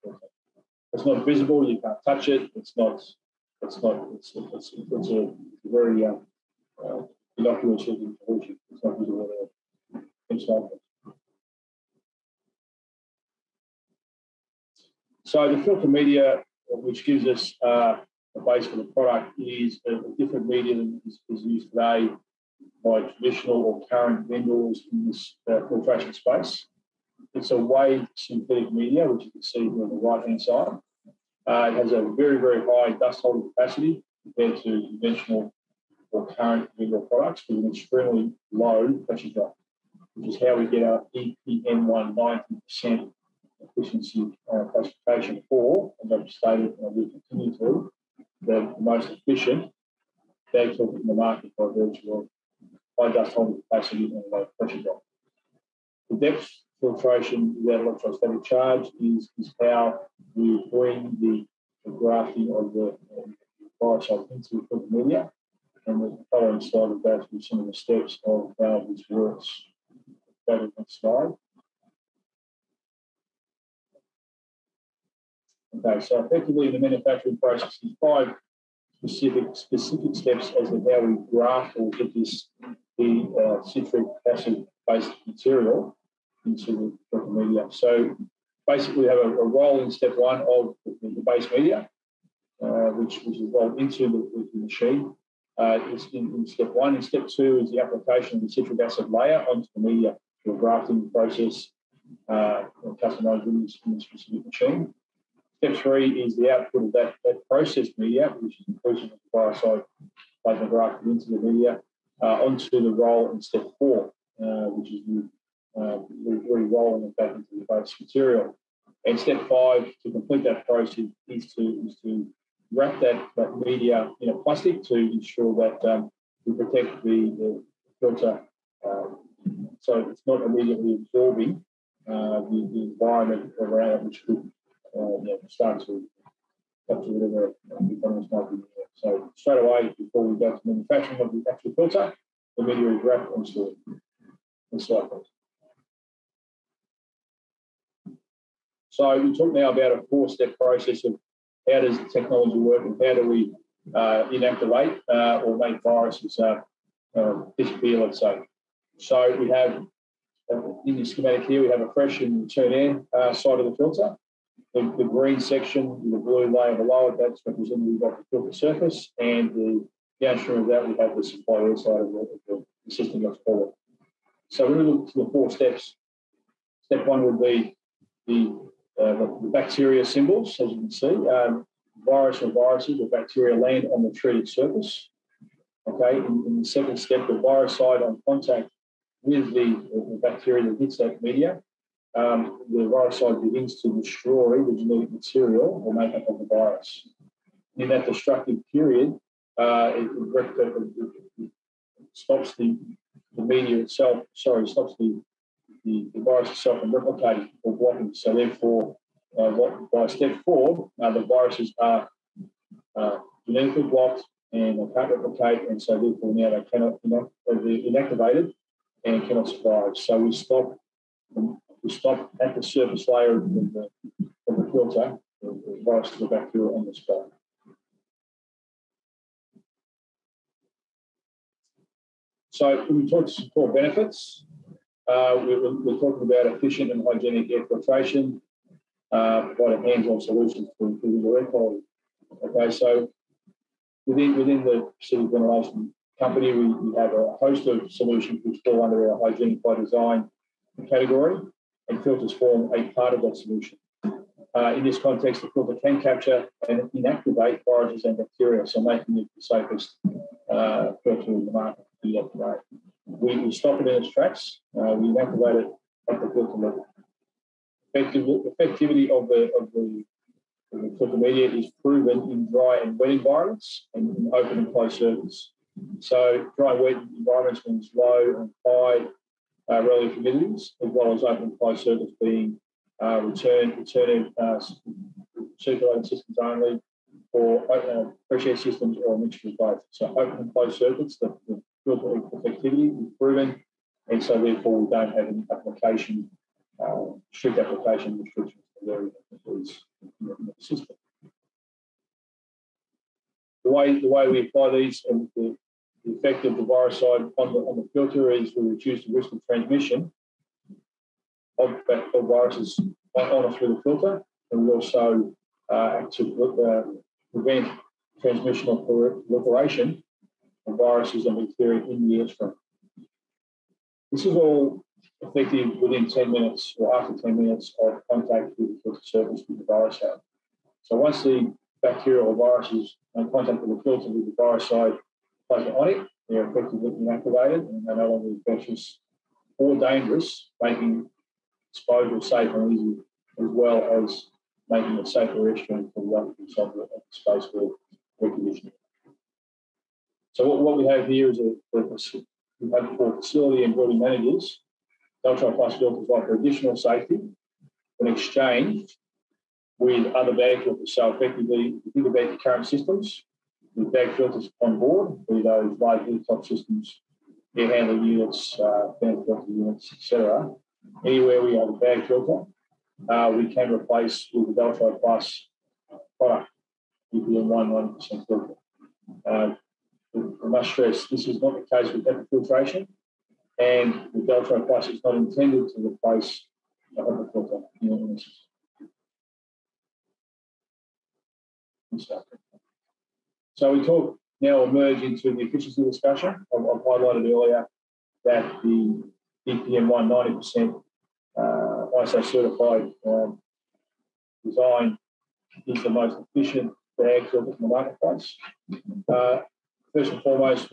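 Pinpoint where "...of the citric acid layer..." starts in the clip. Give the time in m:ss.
1:38.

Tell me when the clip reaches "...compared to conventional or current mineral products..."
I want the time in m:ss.
0:34.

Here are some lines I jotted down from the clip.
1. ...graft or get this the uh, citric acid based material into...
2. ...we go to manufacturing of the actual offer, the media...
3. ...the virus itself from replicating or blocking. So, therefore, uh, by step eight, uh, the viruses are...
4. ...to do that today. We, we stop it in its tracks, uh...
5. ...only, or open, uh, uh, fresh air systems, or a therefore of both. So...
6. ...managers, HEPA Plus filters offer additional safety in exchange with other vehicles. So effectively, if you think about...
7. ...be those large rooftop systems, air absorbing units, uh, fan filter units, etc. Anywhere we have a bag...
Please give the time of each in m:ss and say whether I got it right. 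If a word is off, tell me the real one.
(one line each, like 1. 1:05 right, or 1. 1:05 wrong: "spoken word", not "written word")
1. 1:21 right
2. 2:20 wrong: "filter", not "offer"
3. 3:26 wrong: "four", not "eight"
4. 4:22 right
5. 4:46 wrong: "mixture", not "therefore"
6. 5:53 wrong: "Deltron", not "HEPA"
7. 6:05 wrong: "handling", not "absorbing".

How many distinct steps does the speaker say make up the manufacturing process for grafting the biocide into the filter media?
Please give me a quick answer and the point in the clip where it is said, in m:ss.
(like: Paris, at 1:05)
5, at 1:18.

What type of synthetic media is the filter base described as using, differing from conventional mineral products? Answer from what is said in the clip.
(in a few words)
Wave synthetic media.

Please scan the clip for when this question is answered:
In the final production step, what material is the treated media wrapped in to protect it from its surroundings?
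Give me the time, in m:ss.
2:04.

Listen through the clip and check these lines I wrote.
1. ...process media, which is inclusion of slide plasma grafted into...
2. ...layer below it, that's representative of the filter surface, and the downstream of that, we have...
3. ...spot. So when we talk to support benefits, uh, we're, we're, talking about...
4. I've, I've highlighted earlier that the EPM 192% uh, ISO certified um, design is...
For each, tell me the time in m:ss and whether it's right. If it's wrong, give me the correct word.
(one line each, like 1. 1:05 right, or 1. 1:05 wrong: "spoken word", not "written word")
1. 1:47 wrong: "biocide", not "slide"
2. 2:46 right
3. 3:46 right
4. 6:36 wrong: "190", not "192".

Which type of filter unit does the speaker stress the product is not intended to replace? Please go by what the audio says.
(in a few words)
HEPA filter units.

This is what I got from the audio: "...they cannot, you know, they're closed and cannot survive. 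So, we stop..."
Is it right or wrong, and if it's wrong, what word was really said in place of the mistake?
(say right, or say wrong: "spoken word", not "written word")
wrong: "inactivated", not "closed".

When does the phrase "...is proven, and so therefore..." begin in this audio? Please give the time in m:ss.
4:53.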